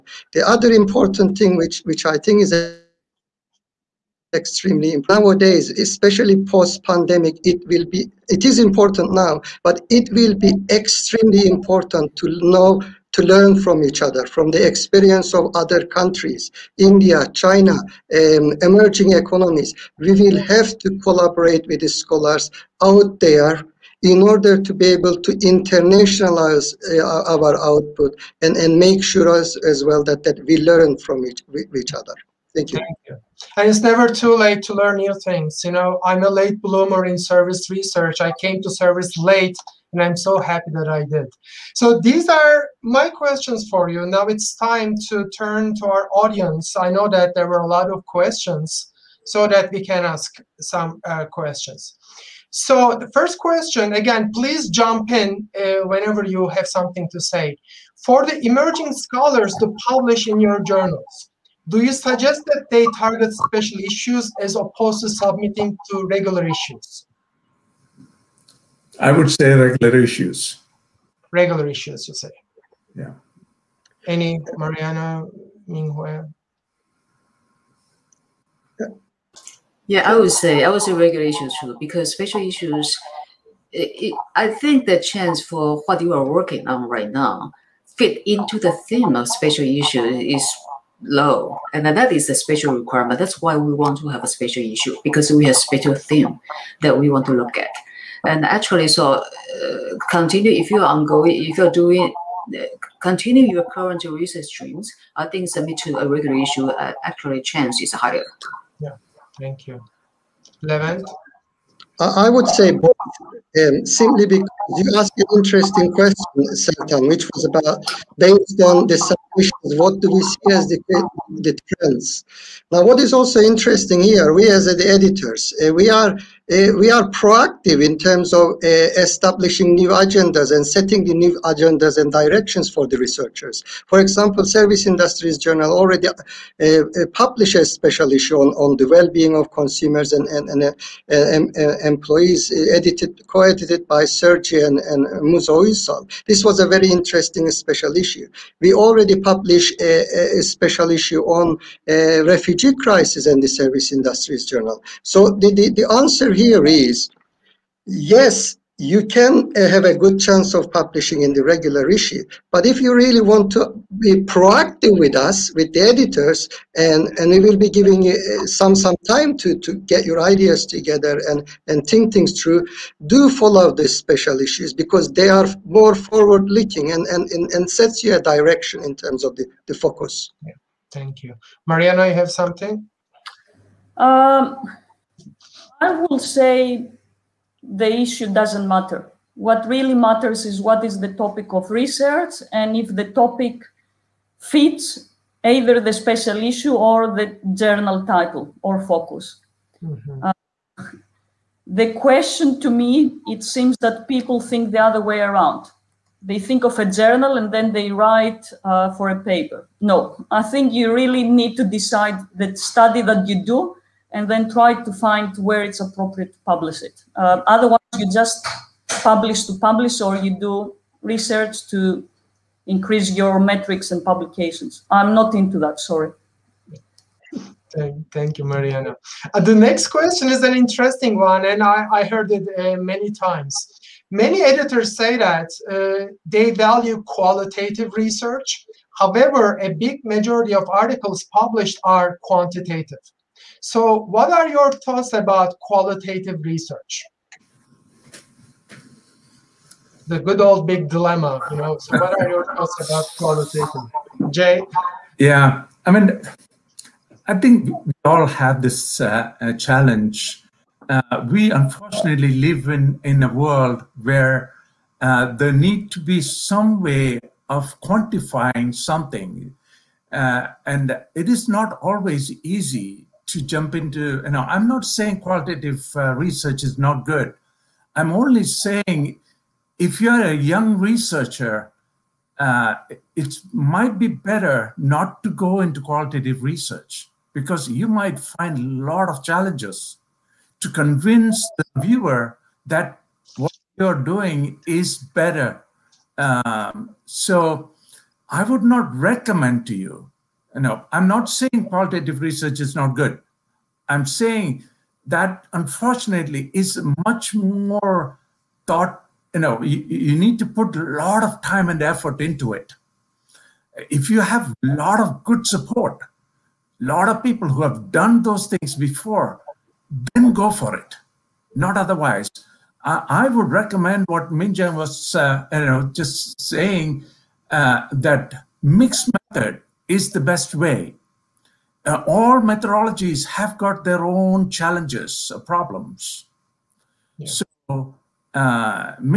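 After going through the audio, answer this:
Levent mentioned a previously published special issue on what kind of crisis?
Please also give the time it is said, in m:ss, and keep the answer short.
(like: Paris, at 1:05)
Refugee crisis, at 2:32.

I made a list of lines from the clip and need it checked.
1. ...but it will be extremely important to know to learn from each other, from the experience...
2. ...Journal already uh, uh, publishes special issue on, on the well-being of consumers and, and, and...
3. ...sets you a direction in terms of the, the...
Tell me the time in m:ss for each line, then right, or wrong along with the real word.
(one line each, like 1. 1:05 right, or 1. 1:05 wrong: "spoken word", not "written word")
1. 0:09 right
2. 2:15 right
3. 2:57 right.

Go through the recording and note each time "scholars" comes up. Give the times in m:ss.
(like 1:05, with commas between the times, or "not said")
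0:21, 0:58.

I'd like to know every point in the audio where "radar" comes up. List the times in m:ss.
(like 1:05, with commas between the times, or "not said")
not said.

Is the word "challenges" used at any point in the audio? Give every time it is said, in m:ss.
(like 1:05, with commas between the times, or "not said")
4:19, 4:49, 5:34.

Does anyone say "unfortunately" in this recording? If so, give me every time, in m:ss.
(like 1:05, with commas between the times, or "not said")
4:21, 5:05.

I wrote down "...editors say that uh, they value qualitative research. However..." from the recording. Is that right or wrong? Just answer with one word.
right.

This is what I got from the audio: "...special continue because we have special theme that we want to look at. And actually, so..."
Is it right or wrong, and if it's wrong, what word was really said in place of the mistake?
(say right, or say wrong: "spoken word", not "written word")
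wrong: "issue", not "continue".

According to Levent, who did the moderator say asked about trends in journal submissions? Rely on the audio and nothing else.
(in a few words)
Sertan.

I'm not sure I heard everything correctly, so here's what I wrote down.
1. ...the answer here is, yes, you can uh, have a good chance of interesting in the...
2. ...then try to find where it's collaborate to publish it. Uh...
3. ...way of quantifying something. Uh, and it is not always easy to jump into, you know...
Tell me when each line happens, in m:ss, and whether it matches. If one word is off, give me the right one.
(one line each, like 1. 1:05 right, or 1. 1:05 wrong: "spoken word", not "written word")
1. 2:35 wrong: "publishing", not "interesting"
2. 3:34 wrong: "appropriate", not "collaborate"
3. 4:26 right.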